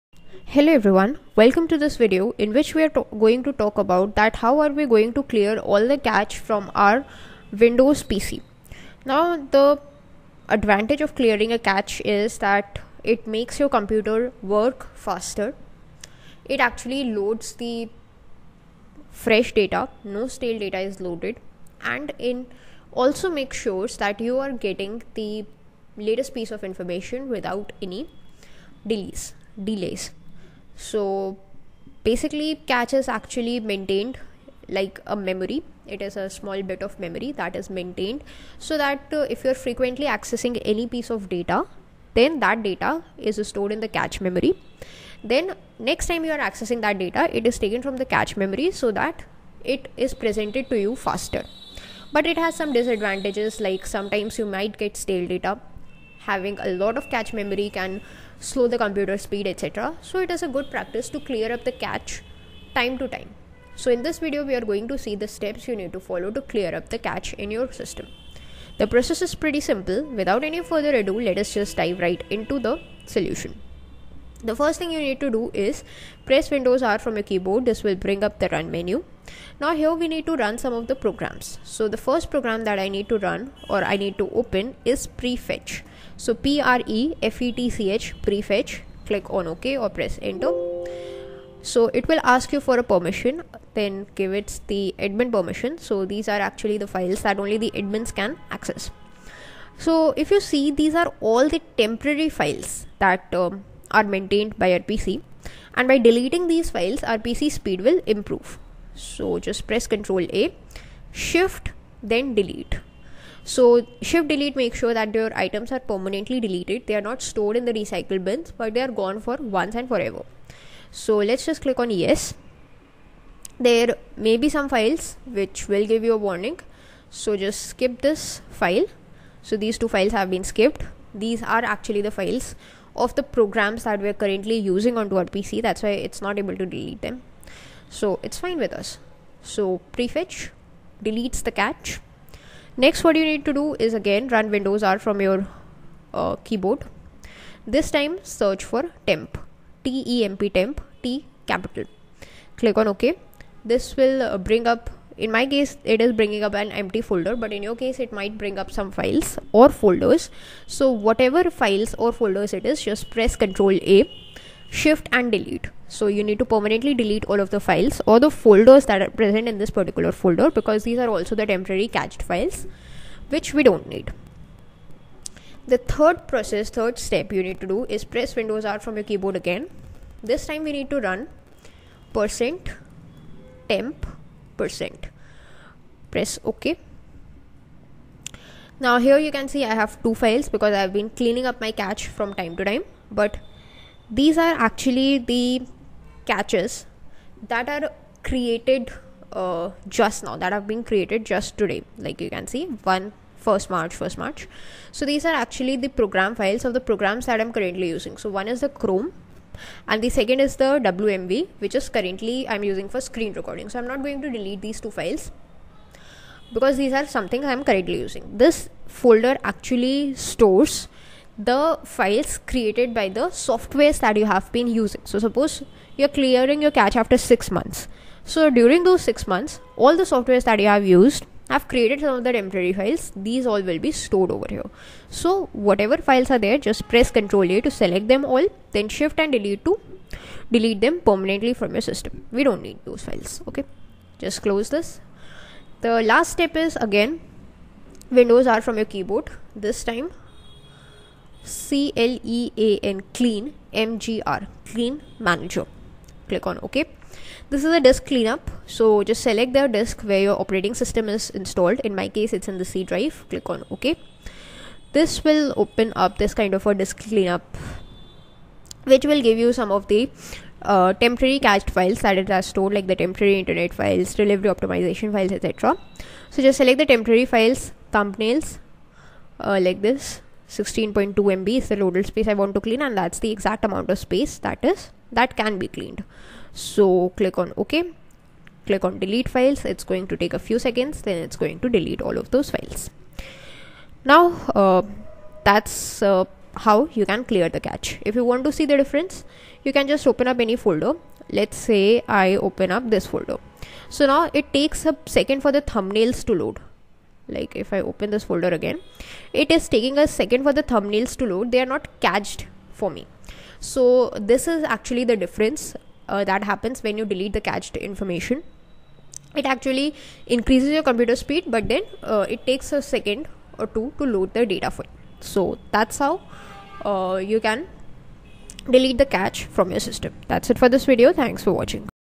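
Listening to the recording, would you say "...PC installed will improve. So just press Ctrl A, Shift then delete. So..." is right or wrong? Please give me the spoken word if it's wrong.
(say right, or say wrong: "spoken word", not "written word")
wrong: "speed", not "installed".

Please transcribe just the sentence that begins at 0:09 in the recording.
Now the advantage of clearing a cache is that it makes your computer work faster.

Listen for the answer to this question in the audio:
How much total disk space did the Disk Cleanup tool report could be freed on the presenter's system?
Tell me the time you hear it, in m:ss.
4:40.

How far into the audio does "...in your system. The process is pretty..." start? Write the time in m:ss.
1:07.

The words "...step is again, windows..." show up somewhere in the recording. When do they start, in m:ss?
4:06.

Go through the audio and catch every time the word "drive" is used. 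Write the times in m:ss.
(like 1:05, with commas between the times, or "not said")
4:22.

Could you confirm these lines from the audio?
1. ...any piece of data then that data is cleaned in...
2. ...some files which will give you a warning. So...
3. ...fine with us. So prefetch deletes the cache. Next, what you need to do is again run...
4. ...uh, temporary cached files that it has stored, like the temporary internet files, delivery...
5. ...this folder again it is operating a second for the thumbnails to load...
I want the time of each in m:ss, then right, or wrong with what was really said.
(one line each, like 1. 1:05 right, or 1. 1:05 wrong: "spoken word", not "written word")
1. 0:40 wrong: "stored", not "cleaned"
2. 2:04 right
3. 2:18 right
4. 4:30 right
5. 5:08 wrong: "taking", not "operating".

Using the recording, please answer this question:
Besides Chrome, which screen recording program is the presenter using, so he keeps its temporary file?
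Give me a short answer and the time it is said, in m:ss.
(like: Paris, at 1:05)
WMV, at 3:30.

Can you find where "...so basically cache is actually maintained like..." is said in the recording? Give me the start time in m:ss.
0:30.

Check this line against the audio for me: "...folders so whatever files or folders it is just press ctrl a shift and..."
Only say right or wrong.
right.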